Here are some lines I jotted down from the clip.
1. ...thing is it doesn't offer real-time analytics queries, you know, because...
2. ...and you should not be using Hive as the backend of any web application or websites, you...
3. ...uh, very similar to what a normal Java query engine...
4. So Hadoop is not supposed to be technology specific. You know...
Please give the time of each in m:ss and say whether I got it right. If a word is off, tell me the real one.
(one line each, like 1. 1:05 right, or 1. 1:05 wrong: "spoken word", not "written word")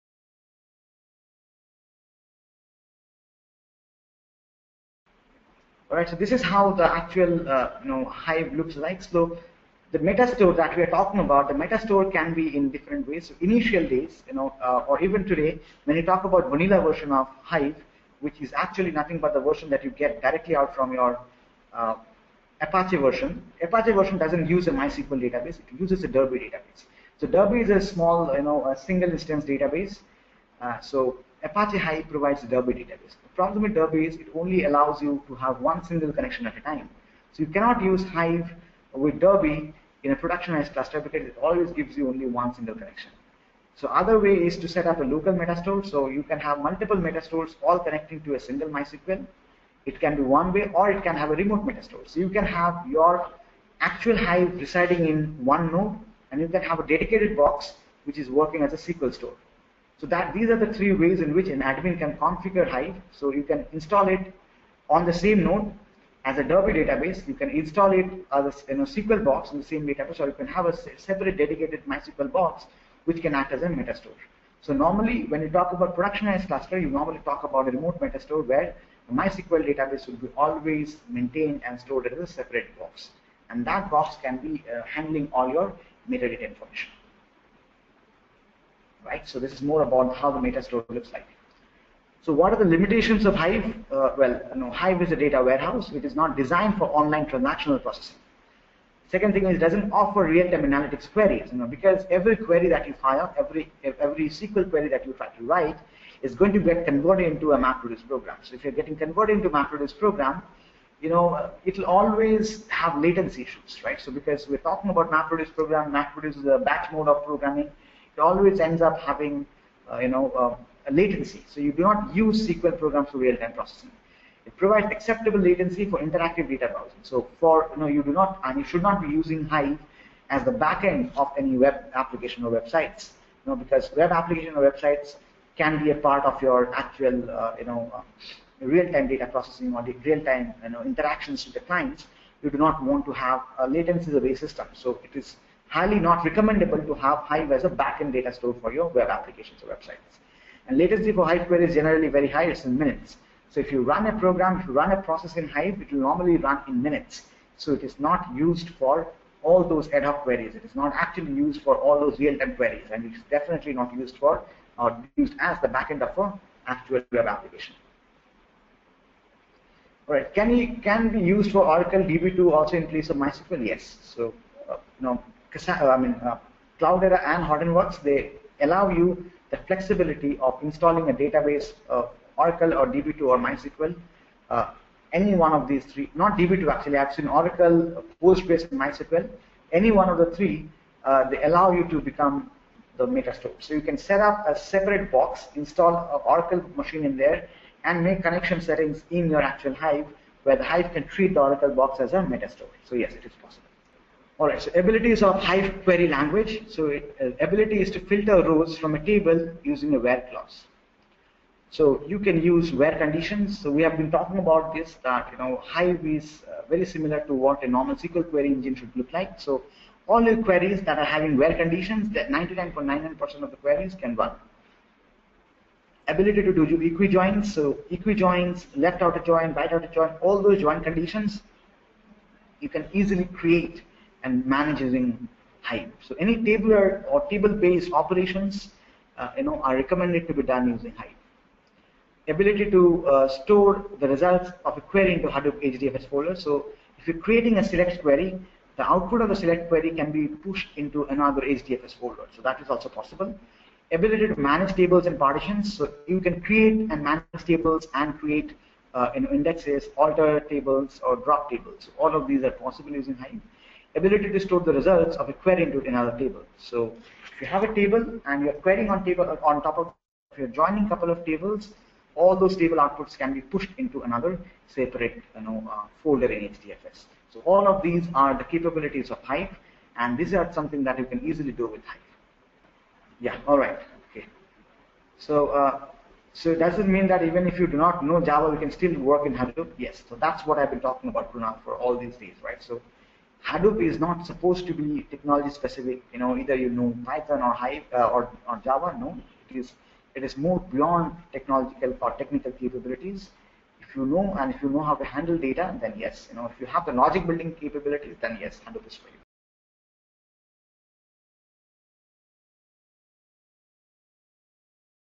1. 1:39 right
2. 2:08 right
3. 3:36 wrong: "SQL", not "Java"
4. 4:52 right.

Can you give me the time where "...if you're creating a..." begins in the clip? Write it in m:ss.
4:06.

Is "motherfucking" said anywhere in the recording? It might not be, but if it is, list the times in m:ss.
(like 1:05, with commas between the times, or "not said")
not said.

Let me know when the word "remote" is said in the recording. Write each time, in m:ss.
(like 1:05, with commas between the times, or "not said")
0:51, 1:17.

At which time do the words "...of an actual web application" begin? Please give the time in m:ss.
2:46.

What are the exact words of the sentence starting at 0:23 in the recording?
Apache version doesn't use a MySQL database; it uses a Derby database.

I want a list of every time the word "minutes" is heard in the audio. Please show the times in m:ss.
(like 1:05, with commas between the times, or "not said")
2:32, 2:36.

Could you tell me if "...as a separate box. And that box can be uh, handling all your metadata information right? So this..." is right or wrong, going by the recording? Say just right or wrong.
right.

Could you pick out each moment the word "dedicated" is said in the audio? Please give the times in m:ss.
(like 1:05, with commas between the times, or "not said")
0:56, 1:11.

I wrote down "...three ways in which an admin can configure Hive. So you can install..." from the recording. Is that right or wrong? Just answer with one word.
right.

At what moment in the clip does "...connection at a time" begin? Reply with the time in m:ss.
0:36.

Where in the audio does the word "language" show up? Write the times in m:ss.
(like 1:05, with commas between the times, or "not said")
3:26.